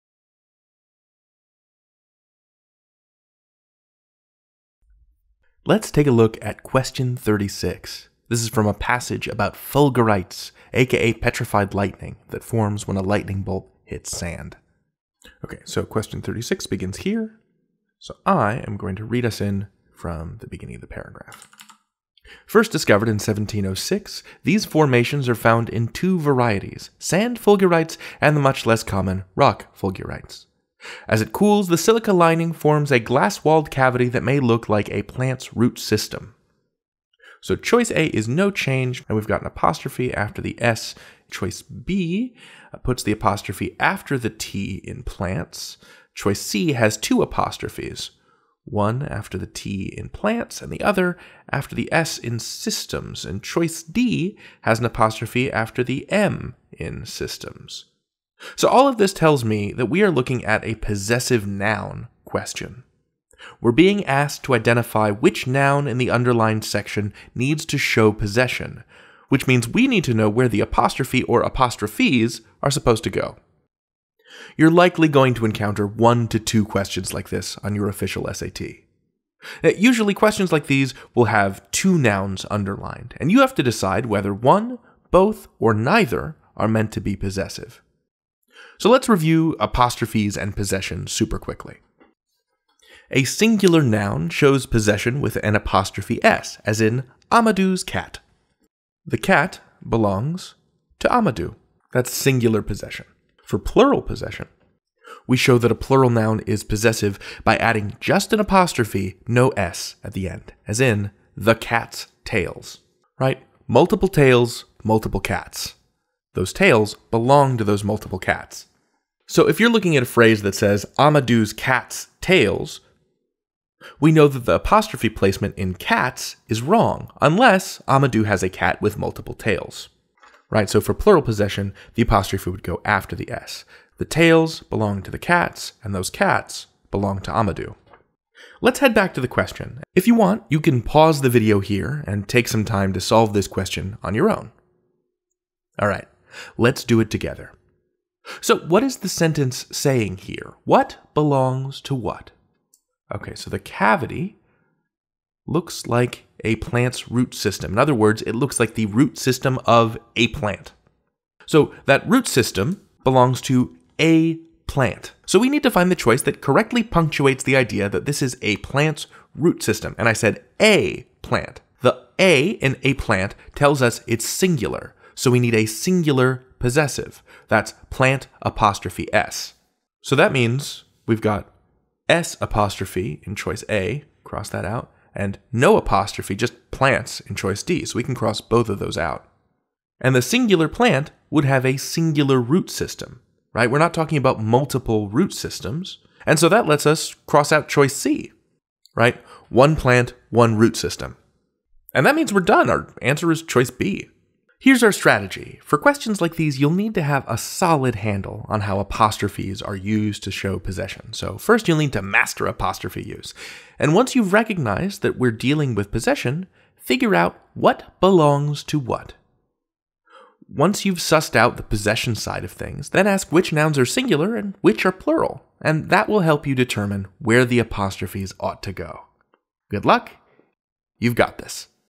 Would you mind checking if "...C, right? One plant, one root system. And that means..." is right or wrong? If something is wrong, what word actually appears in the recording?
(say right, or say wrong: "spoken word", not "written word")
right.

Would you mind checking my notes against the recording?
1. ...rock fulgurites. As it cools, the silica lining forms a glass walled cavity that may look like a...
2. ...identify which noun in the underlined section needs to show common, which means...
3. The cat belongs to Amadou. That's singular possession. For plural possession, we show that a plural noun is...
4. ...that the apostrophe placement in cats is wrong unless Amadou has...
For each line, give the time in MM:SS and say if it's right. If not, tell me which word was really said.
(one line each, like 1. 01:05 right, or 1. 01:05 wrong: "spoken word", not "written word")
1. 00:29 right
2. 01:04 wrong: "possession", not "common"
3. 01:39 right
4. 02:04 right.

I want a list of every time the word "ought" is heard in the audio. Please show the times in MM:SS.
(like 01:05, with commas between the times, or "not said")
03:48.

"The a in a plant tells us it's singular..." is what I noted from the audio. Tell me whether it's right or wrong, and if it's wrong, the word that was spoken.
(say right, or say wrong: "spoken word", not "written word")
right.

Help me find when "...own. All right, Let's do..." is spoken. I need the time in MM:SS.
02:24.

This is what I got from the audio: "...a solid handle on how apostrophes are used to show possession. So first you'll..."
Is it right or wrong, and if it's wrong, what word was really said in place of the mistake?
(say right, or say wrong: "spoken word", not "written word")
right.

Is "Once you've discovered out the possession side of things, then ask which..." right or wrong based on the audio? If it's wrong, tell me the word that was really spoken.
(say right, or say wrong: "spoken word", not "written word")
wrong: "sussed", not "discovered".